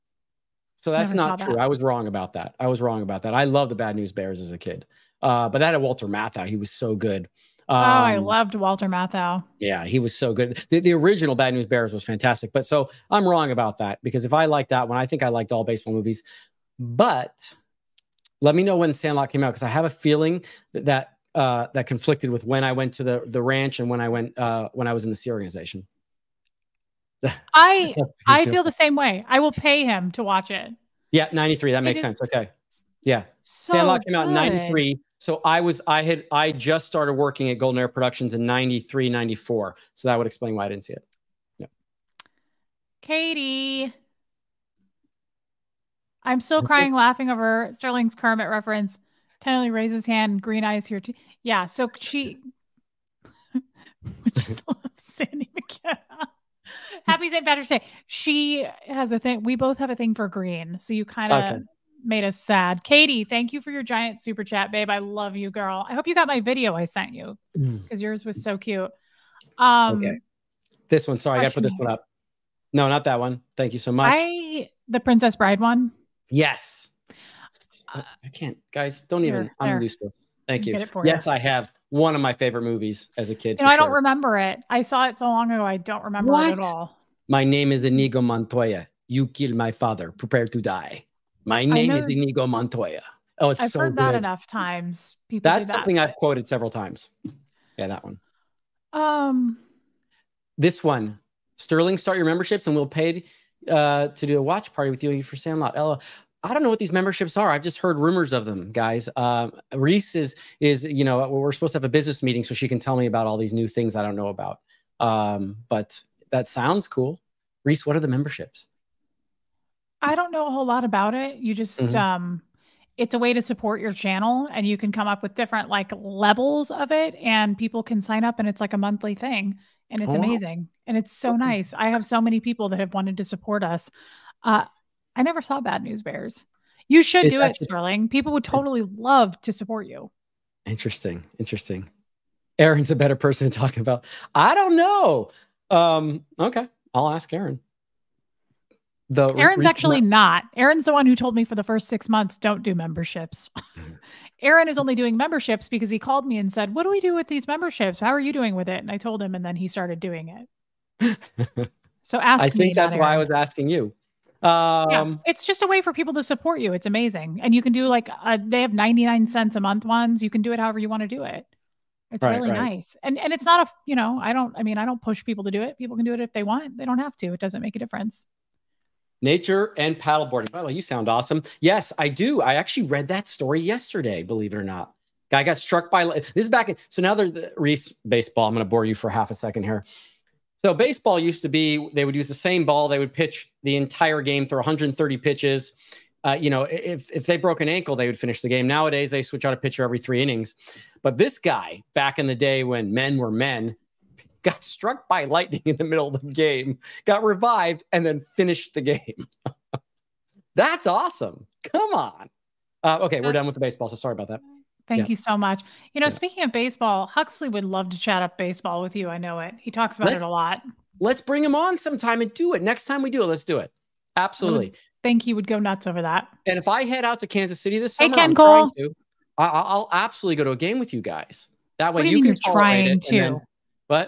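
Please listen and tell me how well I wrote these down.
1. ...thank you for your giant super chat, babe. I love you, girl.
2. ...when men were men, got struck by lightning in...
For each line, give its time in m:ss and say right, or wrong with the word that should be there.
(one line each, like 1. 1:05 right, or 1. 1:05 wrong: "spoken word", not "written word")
1. 1:03 right
2. 3:22 right.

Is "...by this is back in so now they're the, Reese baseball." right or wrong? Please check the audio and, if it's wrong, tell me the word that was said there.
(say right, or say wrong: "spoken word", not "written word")
right.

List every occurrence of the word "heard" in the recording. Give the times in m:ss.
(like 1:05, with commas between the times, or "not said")
1:33, 1:47.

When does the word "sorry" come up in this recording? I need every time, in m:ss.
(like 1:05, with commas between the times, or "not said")
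1:11, 3:33.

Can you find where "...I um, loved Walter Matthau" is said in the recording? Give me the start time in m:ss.
0:07.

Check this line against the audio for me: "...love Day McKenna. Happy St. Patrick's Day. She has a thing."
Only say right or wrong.
wrong.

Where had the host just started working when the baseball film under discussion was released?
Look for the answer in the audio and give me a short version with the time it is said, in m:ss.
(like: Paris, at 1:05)
Golden Era Productions, at 0:37.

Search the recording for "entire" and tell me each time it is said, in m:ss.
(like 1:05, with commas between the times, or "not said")
3:13.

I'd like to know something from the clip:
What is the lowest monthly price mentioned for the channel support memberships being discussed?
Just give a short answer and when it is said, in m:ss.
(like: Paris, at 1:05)
99 cents, at 2:48.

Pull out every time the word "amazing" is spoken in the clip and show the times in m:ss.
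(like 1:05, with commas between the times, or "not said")
2:10, 2:46.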